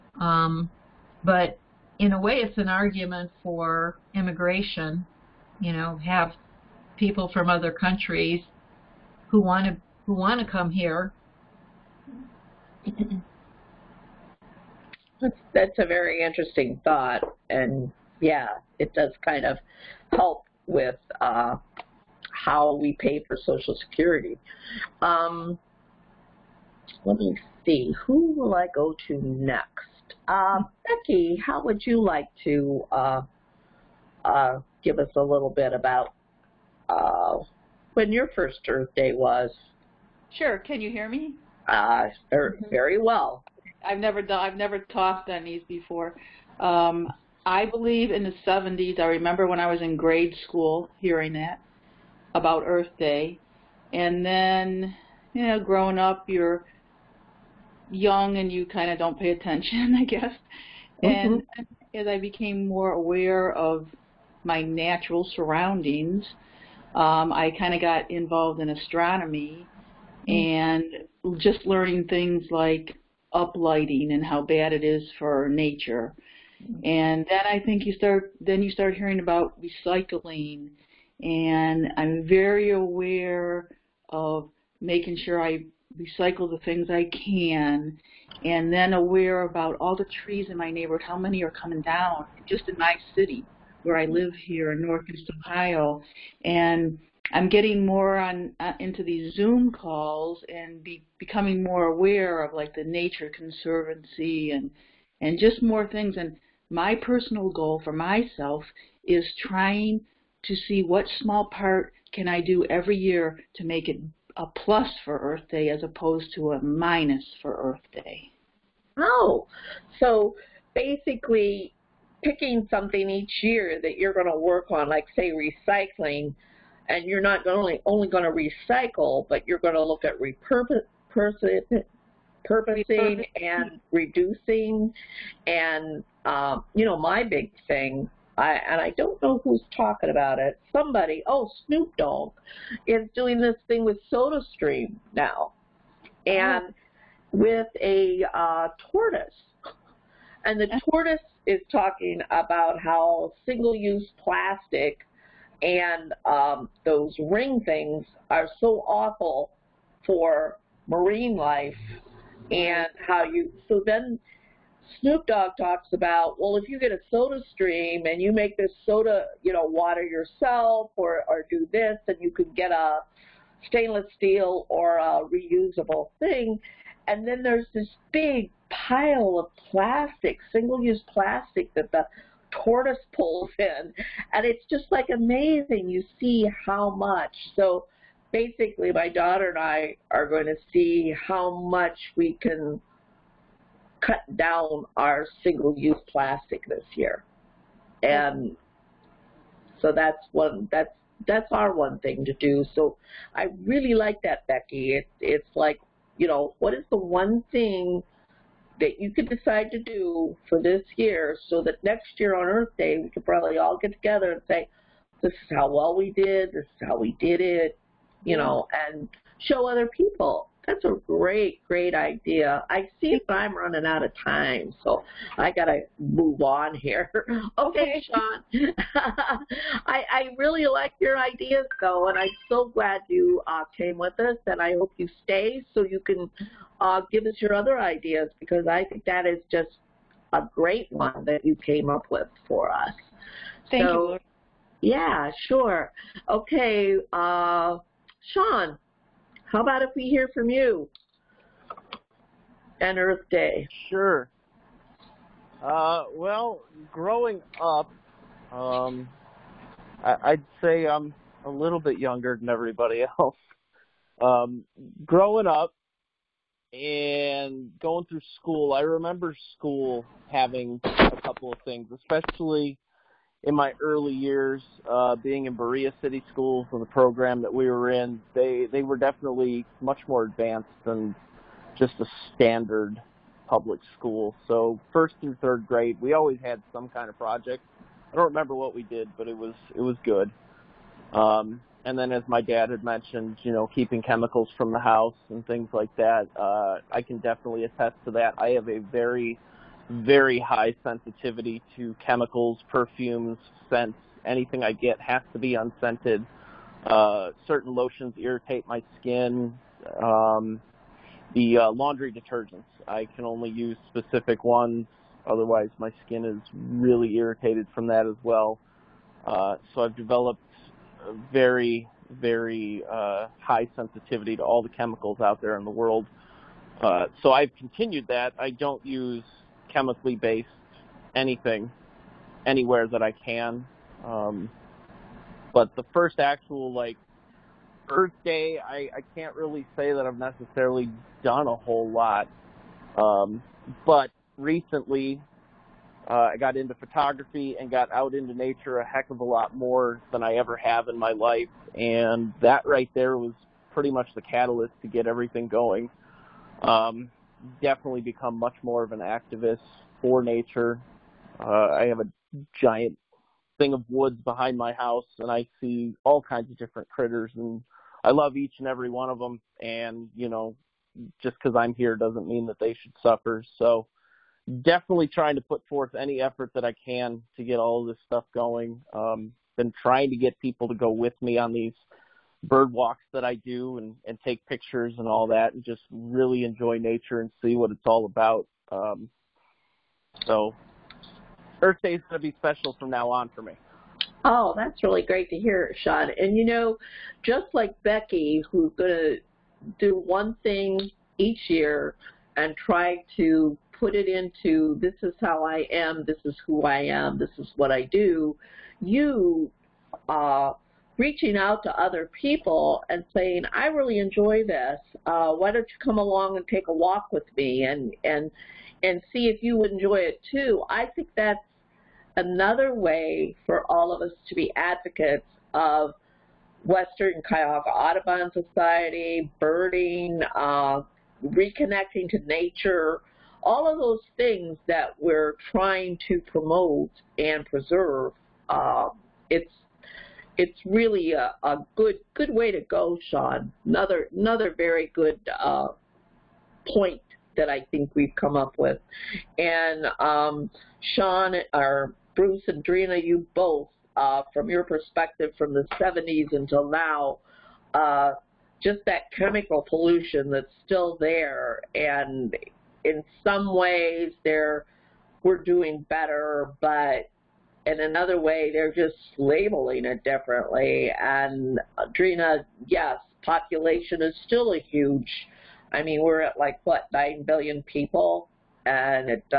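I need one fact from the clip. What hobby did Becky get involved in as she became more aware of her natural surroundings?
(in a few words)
astronomy.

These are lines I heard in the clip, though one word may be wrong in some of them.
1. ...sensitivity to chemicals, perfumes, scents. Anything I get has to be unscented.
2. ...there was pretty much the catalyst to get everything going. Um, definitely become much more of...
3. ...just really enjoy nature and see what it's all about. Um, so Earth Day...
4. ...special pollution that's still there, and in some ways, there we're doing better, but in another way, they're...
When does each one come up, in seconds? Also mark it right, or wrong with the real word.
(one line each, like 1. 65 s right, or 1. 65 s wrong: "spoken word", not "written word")
1. 300 s right
2. 352 s right
3. 385 s right
4. 459 s wrong: "chemical", not "special".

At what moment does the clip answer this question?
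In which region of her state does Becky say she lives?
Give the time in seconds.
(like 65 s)
94 s.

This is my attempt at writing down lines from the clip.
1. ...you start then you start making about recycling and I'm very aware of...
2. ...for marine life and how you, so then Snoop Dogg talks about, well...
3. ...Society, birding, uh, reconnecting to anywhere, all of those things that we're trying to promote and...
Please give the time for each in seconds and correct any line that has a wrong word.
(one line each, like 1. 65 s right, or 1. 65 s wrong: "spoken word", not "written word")
1. 77 s wrong: "hearing", not "making"
2. 160 s right
3. 428 s wrong: "nature", not "anywhere".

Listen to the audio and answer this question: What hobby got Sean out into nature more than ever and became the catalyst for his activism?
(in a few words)
photography.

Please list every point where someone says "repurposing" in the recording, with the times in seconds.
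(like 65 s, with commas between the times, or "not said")
130 s.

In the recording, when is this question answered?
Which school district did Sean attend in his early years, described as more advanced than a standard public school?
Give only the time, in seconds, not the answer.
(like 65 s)
275 s.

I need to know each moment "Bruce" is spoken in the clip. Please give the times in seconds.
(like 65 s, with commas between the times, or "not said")
452 s.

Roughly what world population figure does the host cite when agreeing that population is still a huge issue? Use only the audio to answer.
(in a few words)
9 billion.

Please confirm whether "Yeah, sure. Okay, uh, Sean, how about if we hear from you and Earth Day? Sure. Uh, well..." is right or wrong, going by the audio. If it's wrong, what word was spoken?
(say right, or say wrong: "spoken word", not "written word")
right.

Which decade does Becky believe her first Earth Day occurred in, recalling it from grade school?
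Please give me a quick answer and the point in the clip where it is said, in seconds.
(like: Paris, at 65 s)
the 70s, at 48 s.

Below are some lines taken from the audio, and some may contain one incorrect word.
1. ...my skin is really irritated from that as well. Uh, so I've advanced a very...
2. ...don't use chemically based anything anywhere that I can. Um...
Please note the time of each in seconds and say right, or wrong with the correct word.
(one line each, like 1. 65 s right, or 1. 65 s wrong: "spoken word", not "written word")
1. 315 s wrong: "developed", not "advanced"
2. 328 s right.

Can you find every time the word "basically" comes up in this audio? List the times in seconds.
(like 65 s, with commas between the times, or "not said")
120 s, 188 s.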